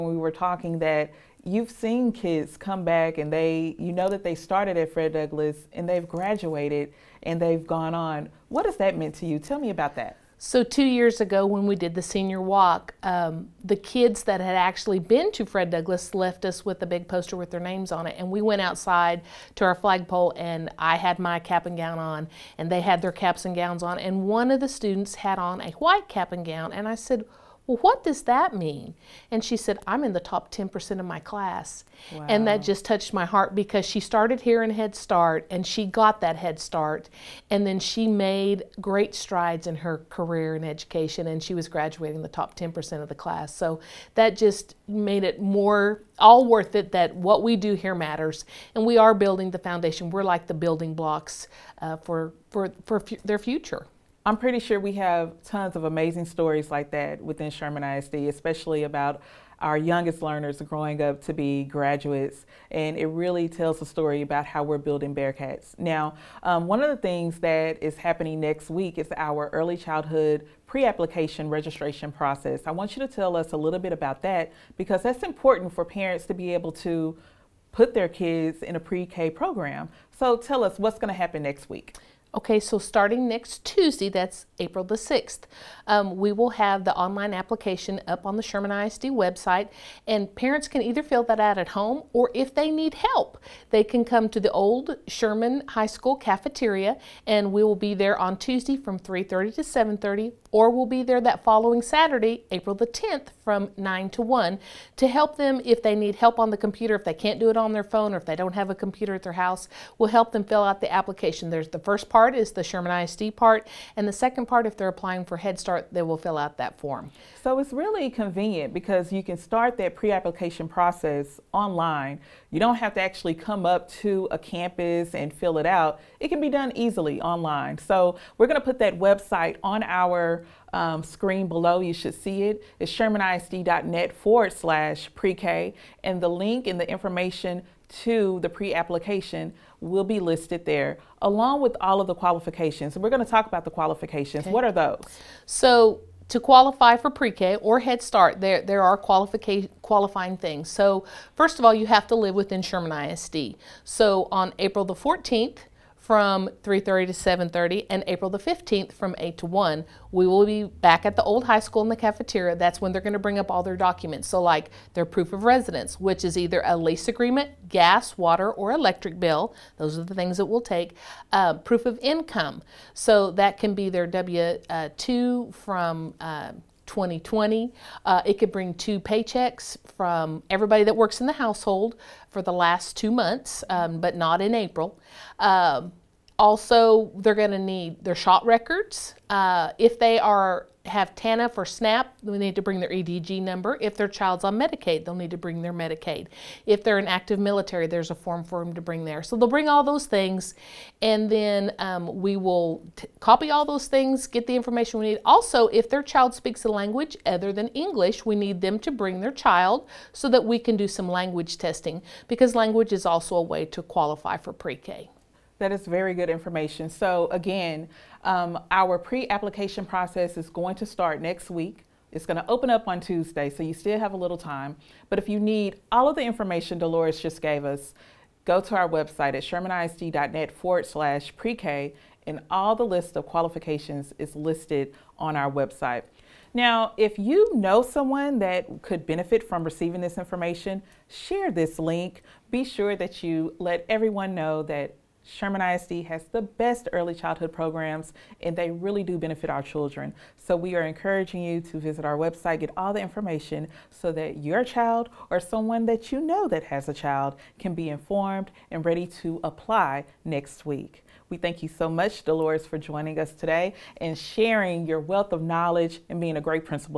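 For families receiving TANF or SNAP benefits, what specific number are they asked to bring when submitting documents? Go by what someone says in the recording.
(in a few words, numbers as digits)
EDG number.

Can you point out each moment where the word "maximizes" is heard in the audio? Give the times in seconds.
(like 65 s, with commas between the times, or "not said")
not said.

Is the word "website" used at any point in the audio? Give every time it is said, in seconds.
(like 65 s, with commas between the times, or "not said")
89 s, 128 s, 228 s, 235 s, 252 s.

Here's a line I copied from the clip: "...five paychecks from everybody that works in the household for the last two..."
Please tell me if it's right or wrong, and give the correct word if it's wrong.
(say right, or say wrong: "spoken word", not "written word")
wrong: "two", not "five".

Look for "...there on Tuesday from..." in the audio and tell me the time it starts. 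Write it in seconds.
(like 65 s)
97 s.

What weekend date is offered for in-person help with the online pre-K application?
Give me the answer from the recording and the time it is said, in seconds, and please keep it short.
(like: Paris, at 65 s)
April 10, at 102 s.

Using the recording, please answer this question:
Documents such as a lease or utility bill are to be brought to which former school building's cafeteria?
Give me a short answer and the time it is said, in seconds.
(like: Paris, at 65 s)
old Sherman High School, at 94 s.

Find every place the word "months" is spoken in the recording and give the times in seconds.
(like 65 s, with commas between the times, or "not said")
183 s.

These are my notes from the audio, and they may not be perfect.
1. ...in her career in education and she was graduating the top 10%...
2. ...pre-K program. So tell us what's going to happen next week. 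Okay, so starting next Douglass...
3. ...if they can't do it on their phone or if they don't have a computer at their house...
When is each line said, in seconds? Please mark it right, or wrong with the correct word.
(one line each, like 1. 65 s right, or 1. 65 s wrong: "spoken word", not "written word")
1. 39 s right
2. 78 s wrong: "Tuesday", not "Douglass"
3. 106 s right.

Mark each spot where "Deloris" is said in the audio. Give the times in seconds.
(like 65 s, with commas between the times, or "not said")
226 s, 262 s.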